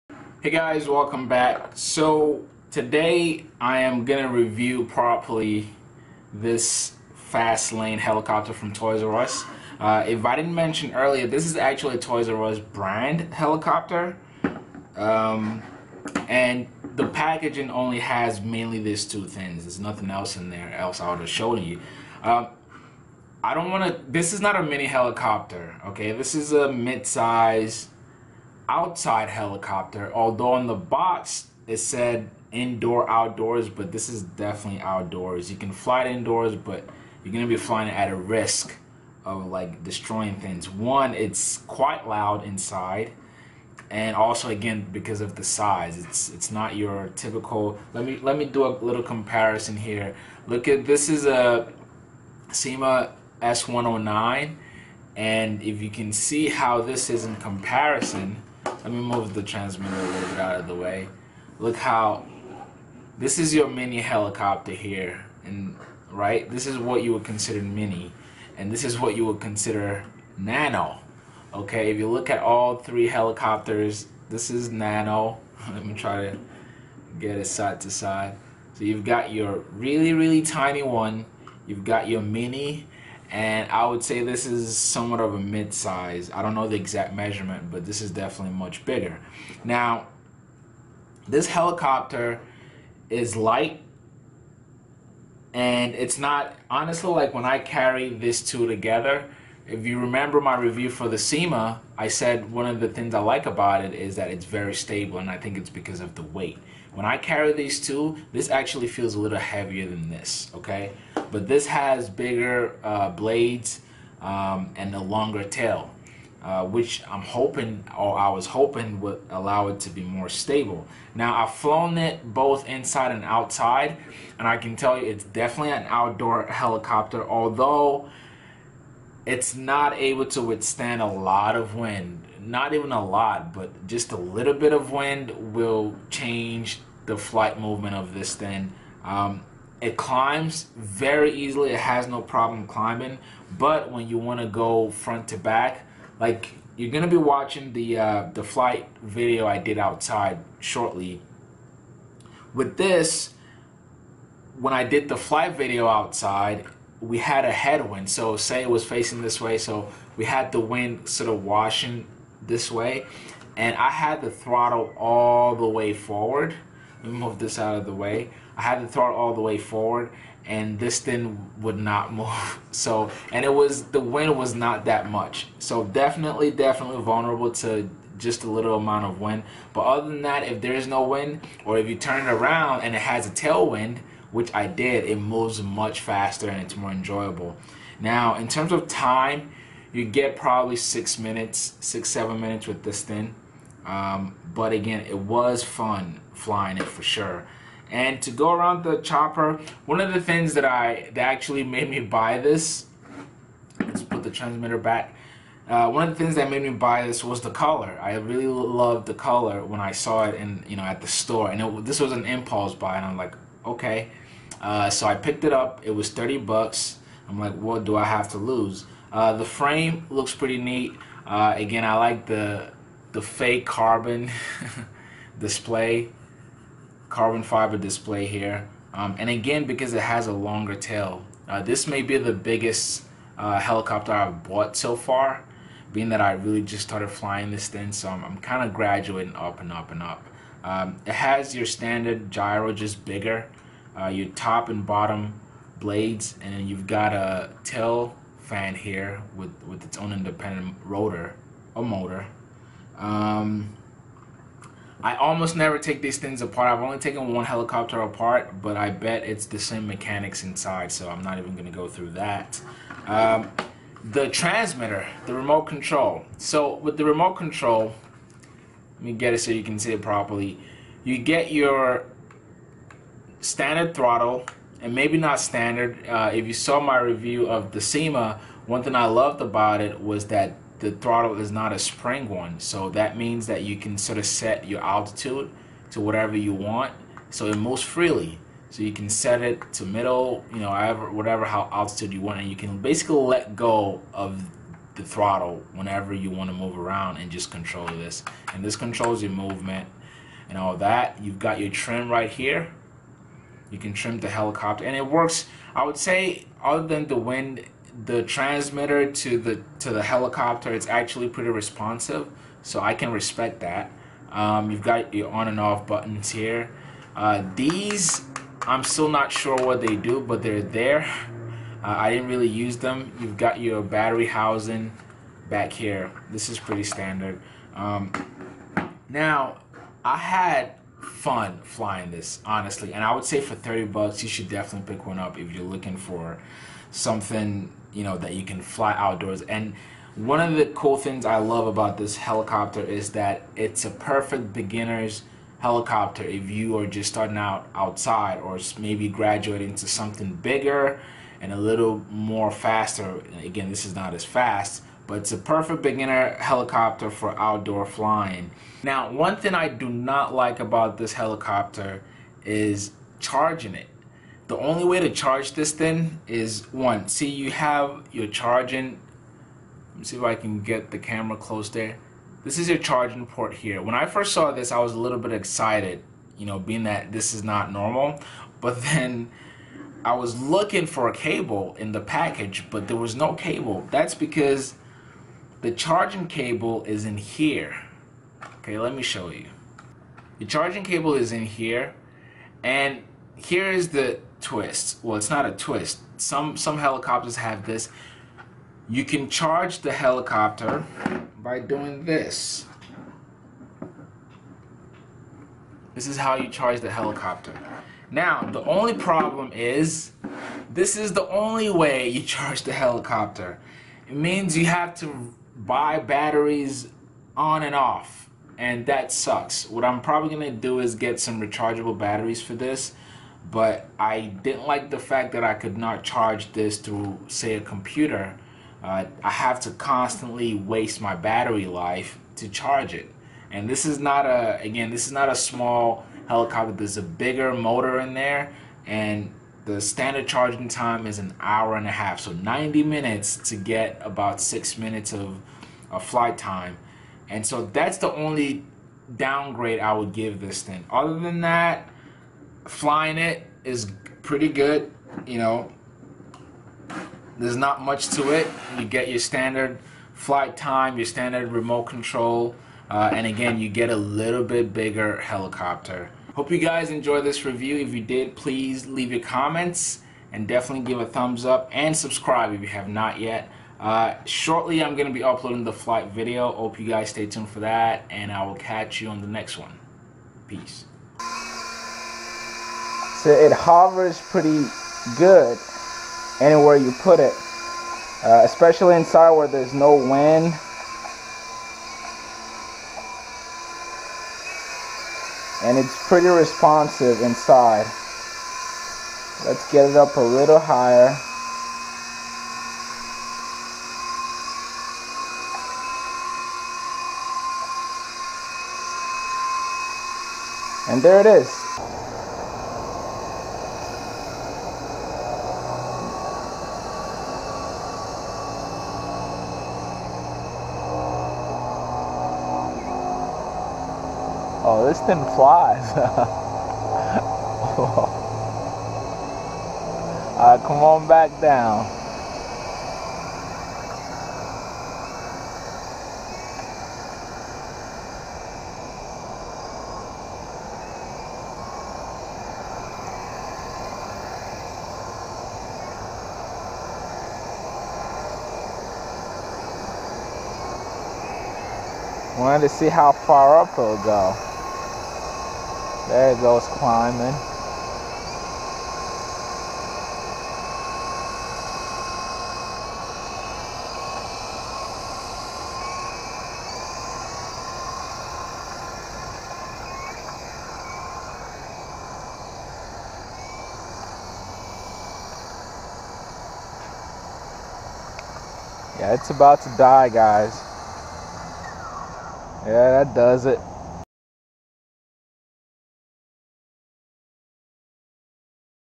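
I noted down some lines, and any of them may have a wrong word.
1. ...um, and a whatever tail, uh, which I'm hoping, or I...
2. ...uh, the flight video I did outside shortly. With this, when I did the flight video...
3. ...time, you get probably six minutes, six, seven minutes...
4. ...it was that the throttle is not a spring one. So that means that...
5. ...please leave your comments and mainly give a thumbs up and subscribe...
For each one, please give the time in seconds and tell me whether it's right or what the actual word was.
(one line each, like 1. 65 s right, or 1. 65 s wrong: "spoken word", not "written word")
1. 114 s wrong: "longer", not "whatever"
2. 147 s right
3. 188 s right
4. 279 s right
5. 468 s wrong: "definitely", not "mainly".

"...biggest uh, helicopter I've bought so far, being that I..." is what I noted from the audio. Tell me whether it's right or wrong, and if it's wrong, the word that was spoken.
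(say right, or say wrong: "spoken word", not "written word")
right.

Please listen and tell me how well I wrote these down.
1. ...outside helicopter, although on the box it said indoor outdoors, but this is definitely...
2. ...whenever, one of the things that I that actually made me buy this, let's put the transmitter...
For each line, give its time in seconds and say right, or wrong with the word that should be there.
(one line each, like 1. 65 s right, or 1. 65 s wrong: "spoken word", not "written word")
1. 28 s right
2. 198 s wrong: "chopper", not "whenever".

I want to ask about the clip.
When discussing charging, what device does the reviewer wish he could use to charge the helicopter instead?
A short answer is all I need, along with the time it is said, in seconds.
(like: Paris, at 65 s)
a computer, at 427 s.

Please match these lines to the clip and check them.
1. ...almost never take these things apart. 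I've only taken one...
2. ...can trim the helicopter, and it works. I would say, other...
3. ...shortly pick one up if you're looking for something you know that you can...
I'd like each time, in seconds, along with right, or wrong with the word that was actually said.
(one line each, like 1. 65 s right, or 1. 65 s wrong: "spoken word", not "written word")
1. 255 s right
2. 303 s right
3. 334 s wrong: "definitely", not "shortly".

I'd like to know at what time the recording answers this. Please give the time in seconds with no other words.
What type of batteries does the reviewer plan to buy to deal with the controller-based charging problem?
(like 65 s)
421 s.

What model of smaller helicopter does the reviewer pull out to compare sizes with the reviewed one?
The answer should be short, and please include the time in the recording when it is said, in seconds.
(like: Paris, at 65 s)
Syma S109, at 52 s.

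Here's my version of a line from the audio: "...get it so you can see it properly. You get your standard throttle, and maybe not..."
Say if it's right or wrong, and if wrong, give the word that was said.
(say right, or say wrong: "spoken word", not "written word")
right.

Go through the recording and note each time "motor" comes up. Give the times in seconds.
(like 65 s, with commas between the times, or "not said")
251 s, 437 s.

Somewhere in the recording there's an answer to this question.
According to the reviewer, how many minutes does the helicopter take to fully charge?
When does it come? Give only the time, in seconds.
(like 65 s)
442 s.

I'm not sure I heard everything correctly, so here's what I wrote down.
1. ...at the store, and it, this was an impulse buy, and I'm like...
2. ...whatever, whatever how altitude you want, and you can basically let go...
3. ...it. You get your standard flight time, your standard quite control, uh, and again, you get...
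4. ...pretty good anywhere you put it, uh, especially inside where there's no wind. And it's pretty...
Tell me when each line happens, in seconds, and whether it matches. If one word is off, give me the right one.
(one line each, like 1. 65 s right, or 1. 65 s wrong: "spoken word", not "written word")
1. 210 s right
2. 290 s right
3. 458 s wrong: "remote", not "quite"
4. 484 s right.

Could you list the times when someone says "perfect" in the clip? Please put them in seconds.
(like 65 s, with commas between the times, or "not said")
343 s, 355 s.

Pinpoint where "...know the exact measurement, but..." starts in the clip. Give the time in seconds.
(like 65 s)
86 s.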